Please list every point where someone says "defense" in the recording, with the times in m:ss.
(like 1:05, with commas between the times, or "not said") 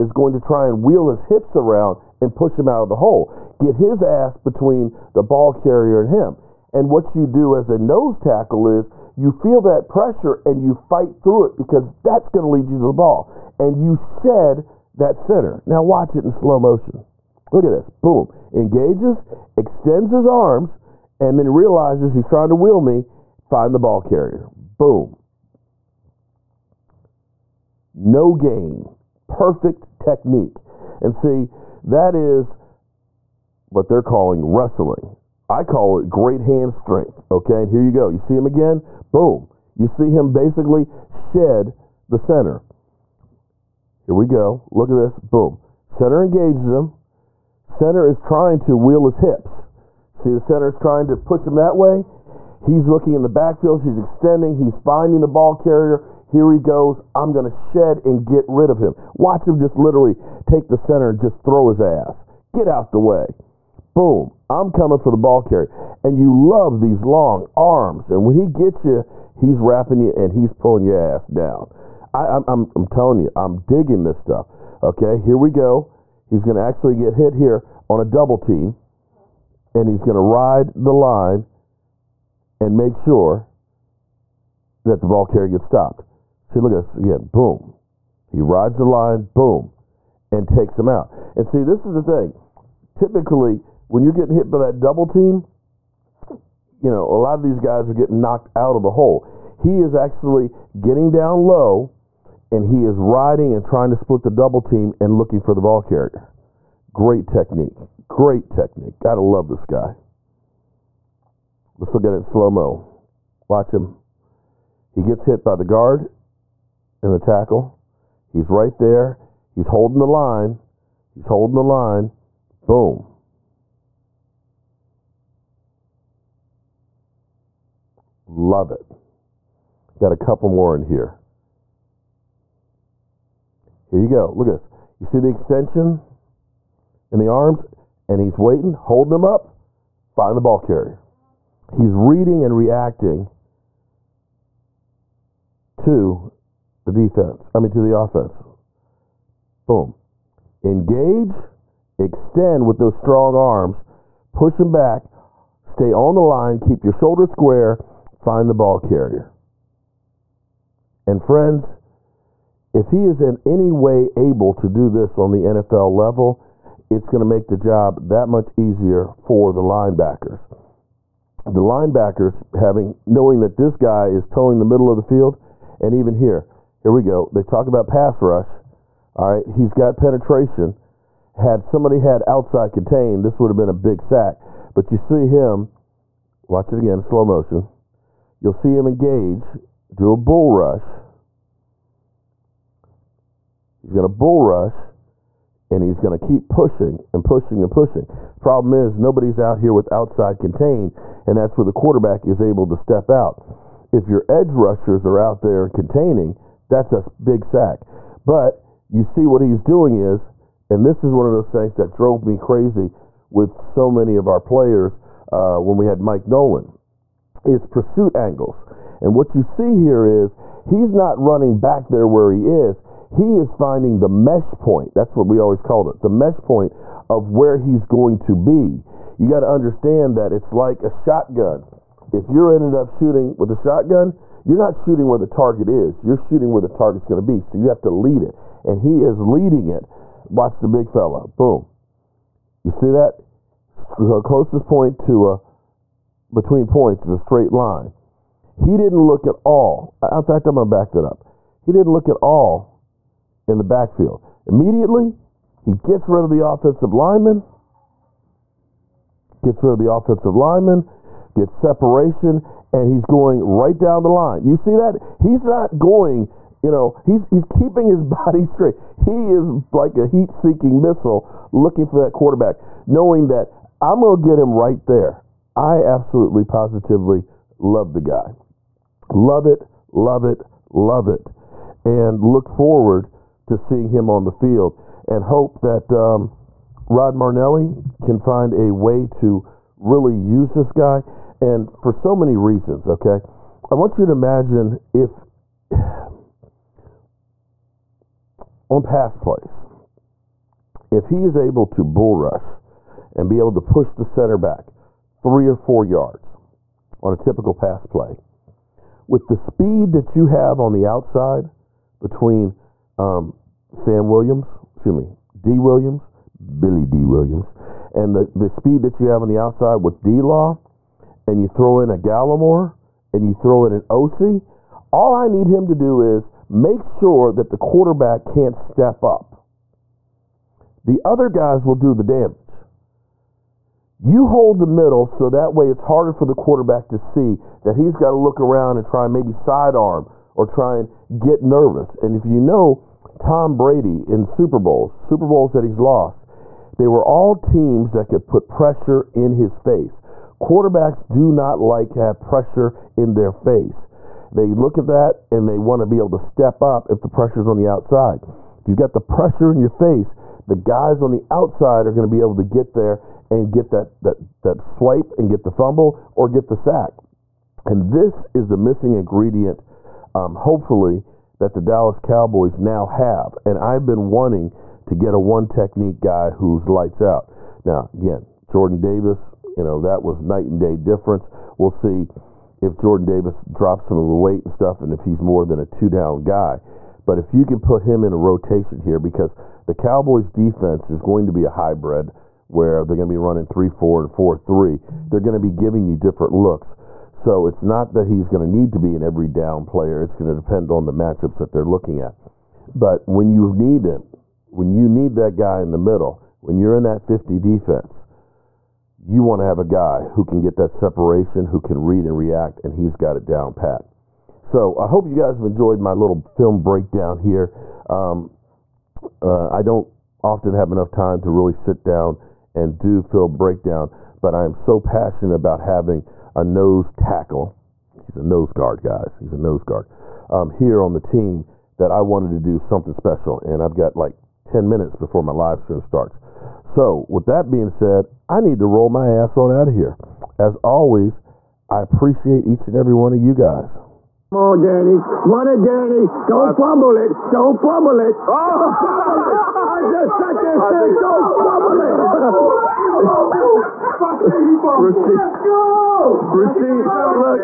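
2:26, 6:30, 6:47.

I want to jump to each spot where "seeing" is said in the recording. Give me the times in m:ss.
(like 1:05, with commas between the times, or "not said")
4:43.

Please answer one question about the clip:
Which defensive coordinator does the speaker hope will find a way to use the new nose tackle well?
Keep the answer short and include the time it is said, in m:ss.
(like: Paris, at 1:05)
Rod Marinelli, at 4:46.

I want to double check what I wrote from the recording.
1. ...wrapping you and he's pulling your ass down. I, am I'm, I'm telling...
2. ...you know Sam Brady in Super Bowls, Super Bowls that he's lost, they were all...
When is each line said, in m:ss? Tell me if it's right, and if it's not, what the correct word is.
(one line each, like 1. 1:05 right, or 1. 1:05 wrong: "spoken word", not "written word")
1. 1:09 right
2. 5:42 wrong: "Tom", not "Sam".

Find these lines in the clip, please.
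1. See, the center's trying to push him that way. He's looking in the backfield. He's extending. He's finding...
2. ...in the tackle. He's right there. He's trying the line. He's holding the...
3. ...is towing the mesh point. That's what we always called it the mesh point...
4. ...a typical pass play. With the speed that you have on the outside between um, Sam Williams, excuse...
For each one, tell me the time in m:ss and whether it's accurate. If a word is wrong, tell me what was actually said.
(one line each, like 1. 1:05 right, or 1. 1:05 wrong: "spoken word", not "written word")
1. 0:50 right
2. 1:57 wrong: "holding", not "trying"
3. 3:43 wrong: "finding", not "towing"
4. 5:07 right.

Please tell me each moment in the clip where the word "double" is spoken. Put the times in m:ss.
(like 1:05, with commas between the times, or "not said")
1:18, 1:34, 1:44.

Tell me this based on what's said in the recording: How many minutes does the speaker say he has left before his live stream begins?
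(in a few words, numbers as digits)
10.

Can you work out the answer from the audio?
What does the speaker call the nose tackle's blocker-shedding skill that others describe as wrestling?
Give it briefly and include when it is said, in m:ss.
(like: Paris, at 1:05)
Great hand strength, at 0:36.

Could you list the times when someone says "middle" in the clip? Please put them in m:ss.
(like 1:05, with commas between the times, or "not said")
2:54, 5:34, 6:45.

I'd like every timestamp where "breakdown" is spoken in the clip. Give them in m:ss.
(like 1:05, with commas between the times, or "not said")
6:56, 7:03.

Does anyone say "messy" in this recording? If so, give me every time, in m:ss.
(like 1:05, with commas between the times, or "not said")
not said.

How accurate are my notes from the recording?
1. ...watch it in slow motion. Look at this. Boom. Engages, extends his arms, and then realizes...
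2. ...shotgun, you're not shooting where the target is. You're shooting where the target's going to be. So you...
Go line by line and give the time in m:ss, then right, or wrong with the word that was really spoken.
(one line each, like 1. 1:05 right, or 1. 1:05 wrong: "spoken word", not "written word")
1. 0:15 right
2. 3:53 right.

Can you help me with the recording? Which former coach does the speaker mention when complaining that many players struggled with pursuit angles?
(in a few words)
Mike Nolan.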